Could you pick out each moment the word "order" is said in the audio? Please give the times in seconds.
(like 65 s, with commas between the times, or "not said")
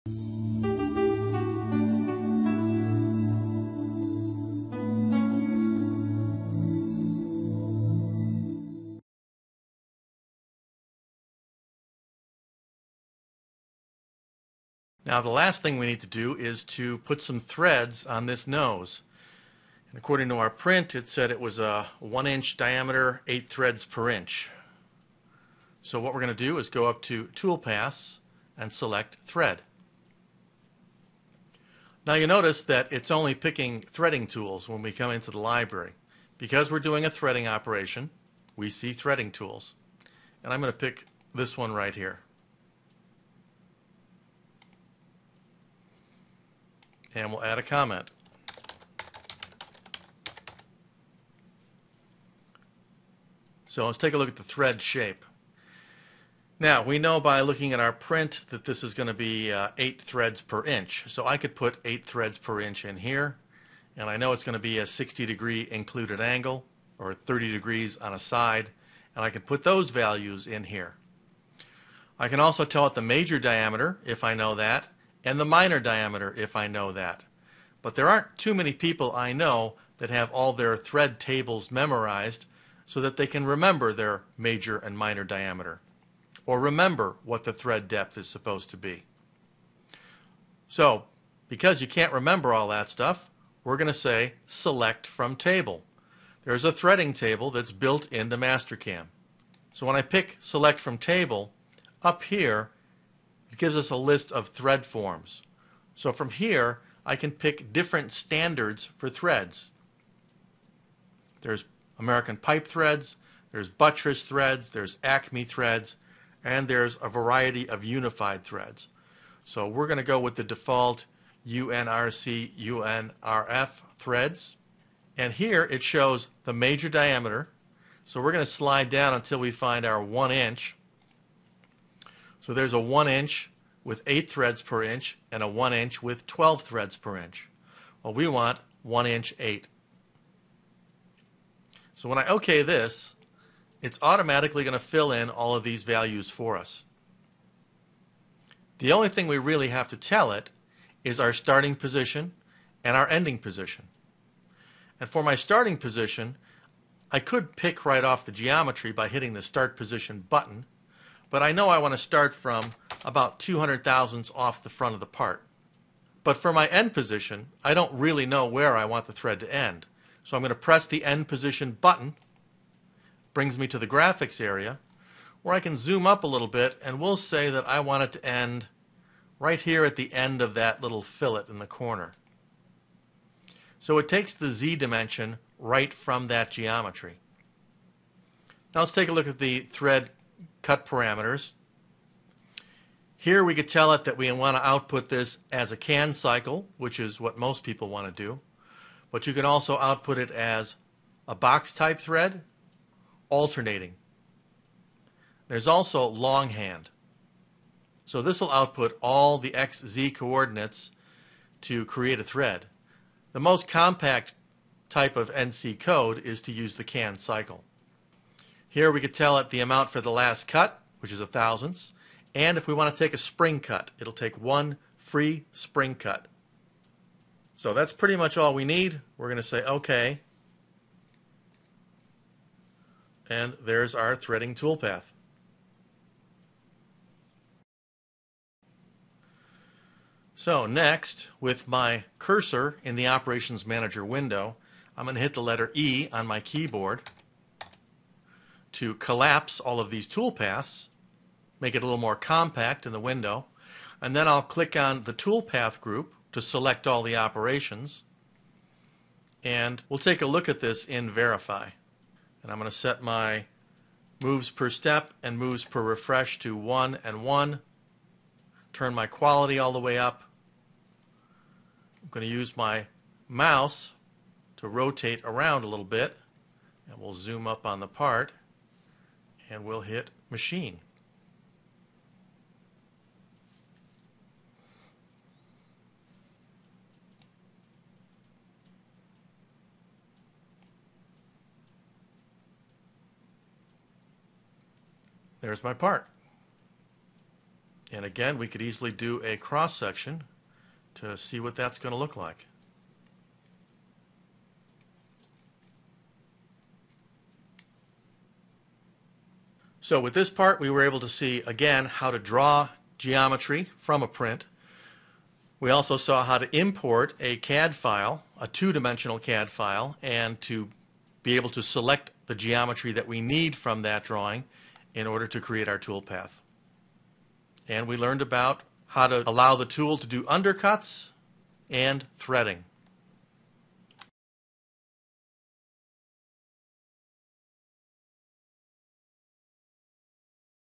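325 s.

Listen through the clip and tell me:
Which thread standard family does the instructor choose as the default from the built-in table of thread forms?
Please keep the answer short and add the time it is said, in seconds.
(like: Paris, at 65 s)
UNRC, UNRF, at 121 s.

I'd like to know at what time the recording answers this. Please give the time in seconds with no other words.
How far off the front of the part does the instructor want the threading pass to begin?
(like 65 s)
163 s.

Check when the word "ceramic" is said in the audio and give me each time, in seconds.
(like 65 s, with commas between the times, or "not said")
not said.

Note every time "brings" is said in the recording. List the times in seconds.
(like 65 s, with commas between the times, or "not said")
173 s.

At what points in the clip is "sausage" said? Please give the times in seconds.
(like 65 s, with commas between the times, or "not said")
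not said.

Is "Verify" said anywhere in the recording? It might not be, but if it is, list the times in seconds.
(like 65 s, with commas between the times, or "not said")
261 s.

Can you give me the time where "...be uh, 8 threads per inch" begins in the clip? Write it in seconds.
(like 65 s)
59 s.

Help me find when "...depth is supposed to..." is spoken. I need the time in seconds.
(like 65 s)
87 s.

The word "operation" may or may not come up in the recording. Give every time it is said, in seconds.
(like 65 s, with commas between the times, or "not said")
37 s, 243 s, 257 s.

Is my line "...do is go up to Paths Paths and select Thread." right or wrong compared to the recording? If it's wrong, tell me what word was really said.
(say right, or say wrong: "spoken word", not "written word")
wrong: "Tool", not "Paths".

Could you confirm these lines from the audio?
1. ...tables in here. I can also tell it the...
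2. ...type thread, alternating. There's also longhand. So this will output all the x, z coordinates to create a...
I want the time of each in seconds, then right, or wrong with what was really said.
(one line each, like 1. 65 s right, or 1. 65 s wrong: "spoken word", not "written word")
1. 69 s wrong: "values", not "tables"
2. 201 s right.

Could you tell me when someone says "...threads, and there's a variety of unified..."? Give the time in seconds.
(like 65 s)
115 s.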